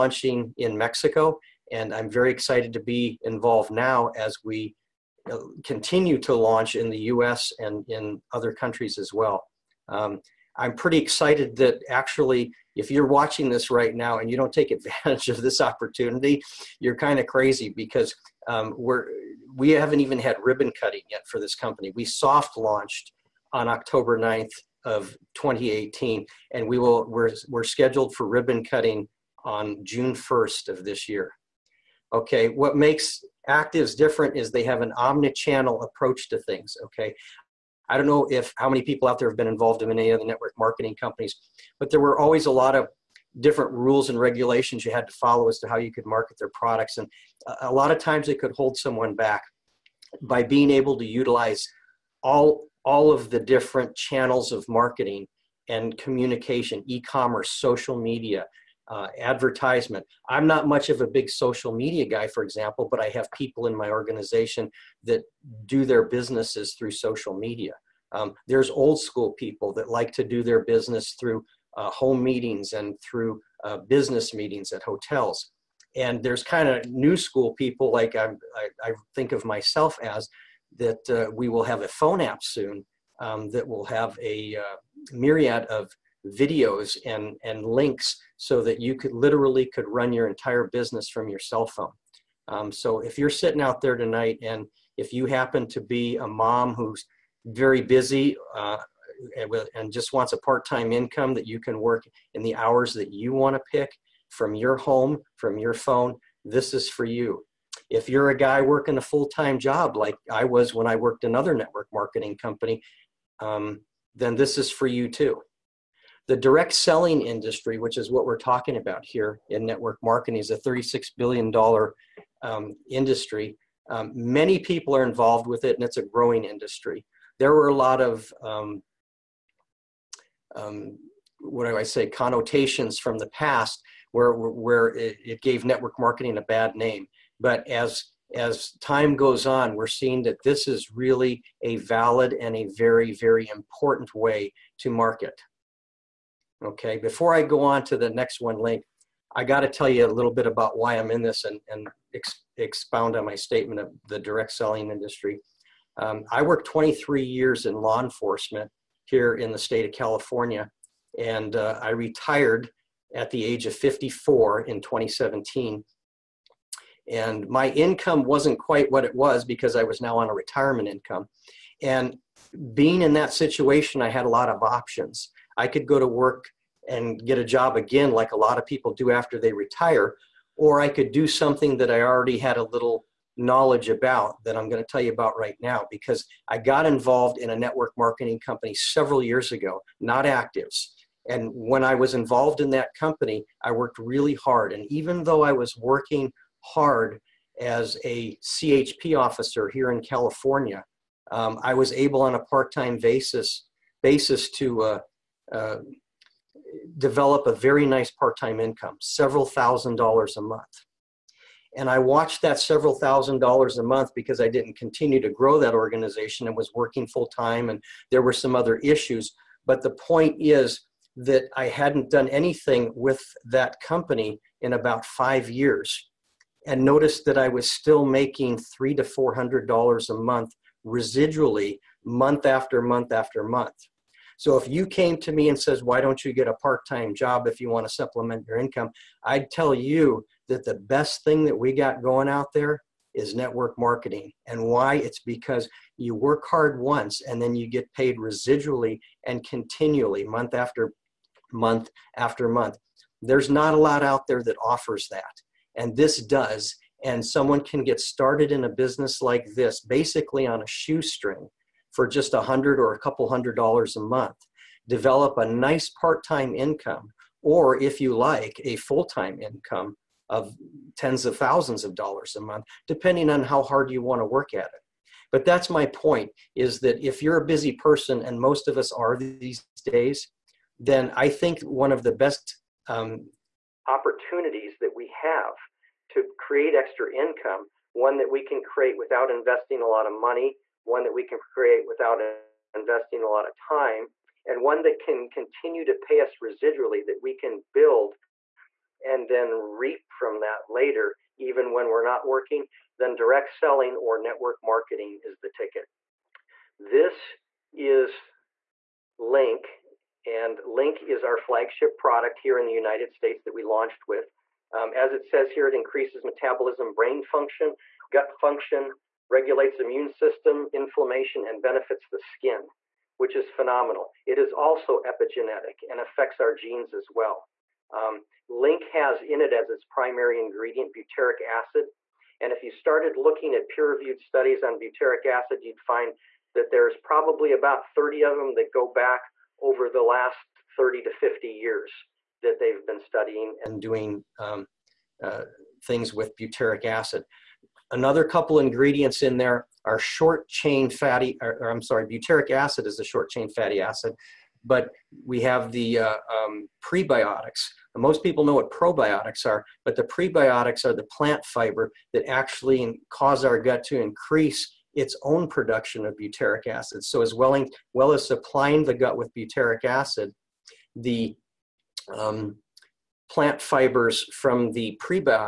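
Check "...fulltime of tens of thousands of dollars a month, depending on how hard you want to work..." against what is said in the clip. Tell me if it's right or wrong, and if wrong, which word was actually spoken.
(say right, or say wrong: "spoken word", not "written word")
wrong: "income", not "fulltime".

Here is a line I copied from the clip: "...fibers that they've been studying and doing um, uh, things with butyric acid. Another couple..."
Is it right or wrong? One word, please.
wrong.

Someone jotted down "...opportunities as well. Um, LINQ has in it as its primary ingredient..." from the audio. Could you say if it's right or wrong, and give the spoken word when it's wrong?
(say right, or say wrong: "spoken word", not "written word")
wrong: "genes", not "opportunities".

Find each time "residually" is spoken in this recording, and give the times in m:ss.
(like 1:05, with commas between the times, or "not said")
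3:50, 4:08, 4:56.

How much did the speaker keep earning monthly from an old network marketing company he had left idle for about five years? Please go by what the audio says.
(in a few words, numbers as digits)
$300 to $400.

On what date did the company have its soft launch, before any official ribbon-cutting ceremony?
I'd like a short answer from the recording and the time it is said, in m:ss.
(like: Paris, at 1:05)
October 9th, 2018, at 0:23.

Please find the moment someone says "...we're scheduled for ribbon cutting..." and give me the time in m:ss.
0:27.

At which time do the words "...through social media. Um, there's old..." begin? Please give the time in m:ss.
1:06.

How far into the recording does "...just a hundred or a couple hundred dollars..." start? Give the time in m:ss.
4:22.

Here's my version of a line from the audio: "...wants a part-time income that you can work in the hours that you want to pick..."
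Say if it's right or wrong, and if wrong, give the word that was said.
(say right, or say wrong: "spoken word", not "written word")
right.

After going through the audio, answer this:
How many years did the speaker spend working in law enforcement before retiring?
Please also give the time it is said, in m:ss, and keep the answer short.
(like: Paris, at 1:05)
23 years, at 2:36.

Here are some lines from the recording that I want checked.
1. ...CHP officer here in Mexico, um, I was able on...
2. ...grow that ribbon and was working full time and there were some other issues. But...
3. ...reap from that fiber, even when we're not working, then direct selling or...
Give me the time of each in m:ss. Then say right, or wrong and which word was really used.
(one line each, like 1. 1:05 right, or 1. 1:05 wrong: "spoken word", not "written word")
1. 3:18 wrong: "California", not "Mexico"
2. 3:35 wrong: "organization", not "ribbon"
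3. 4:59 wrong: "later", not "fiber".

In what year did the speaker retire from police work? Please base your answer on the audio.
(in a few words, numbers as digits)
2017.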